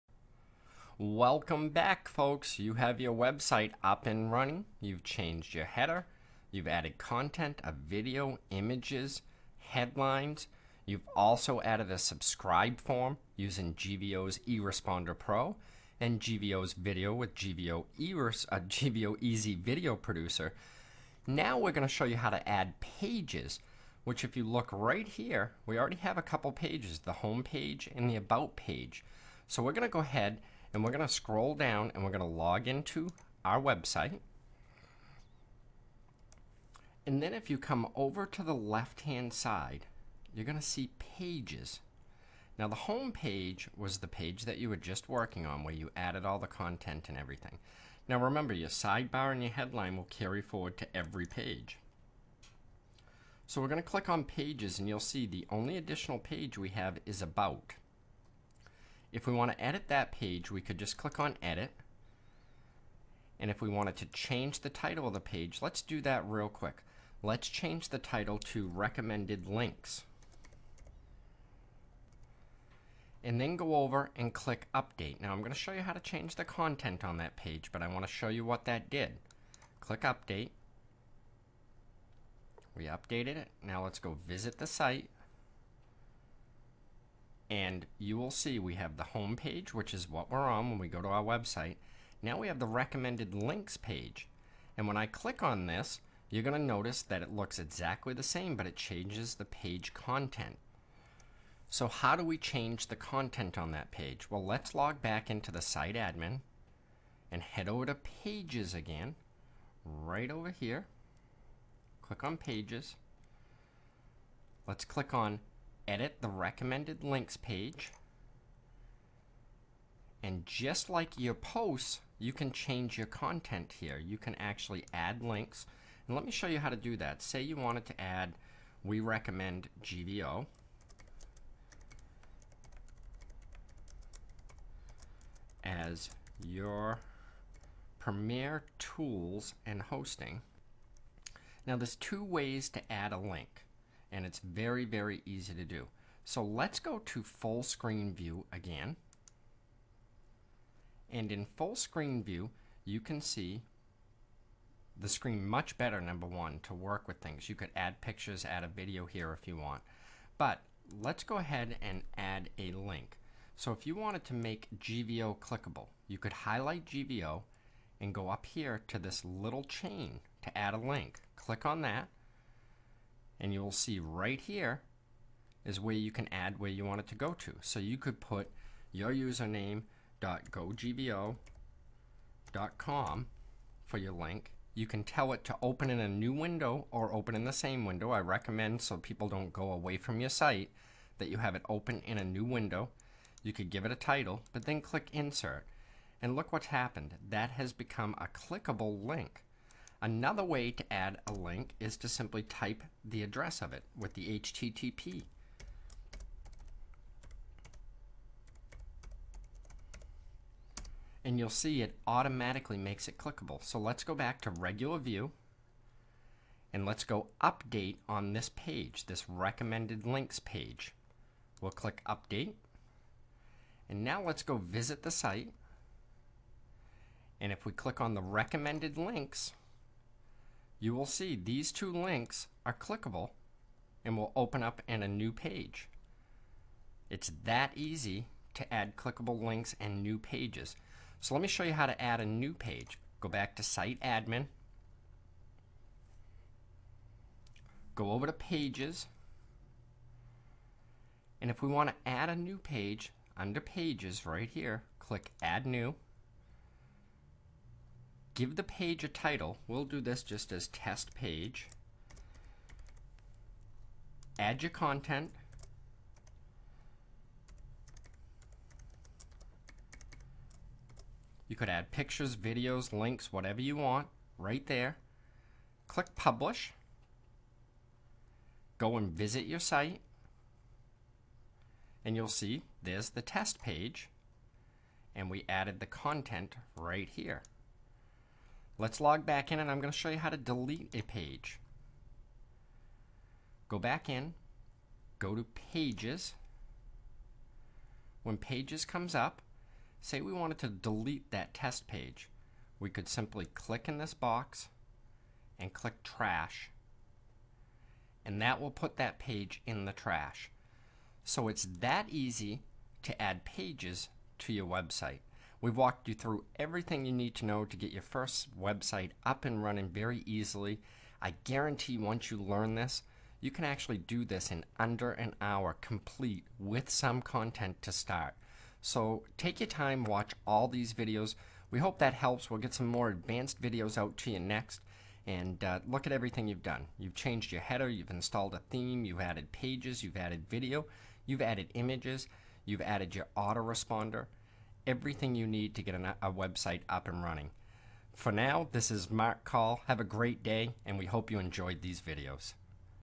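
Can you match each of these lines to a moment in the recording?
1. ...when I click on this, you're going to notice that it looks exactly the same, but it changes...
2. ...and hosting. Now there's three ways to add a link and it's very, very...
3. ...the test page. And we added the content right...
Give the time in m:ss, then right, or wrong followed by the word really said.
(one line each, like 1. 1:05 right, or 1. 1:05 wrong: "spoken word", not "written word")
1. 1:34 right
2. 2:19 wrong: "two", not "three"
3. 4:43 right.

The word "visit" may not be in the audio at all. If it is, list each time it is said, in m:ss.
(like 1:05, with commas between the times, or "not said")
1:24, 3:44, 4:39.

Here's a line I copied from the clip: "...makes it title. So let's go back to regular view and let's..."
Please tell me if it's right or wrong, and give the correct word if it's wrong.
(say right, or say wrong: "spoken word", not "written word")
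wrong: "clickable", not "title".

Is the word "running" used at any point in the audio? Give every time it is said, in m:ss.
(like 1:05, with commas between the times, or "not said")
0:04, 5:19, 5:47.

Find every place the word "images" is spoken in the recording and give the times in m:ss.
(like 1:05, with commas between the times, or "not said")
0:08, 5:41.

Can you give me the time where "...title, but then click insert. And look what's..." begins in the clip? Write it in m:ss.
3:13.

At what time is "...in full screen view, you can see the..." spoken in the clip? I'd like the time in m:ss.
2:31.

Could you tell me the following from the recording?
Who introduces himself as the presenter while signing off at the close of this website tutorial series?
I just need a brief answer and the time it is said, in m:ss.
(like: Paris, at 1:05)
Mark Call, at 5:49.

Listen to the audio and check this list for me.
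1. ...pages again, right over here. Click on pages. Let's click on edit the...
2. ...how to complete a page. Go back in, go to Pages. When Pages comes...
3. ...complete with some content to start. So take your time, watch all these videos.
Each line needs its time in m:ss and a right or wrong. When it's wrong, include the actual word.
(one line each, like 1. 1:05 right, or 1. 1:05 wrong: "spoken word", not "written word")
1. 1:47 right
2. 4:50 wrong: "delete", not "complete"
3. 5:25 right.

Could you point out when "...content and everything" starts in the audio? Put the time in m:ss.
0:46.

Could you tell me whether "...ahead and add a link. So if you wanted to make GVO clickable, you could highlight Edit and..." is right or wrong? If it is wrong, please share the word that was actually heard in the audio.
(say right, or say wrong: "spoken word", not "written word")
wrong: "GVO", not "Edit".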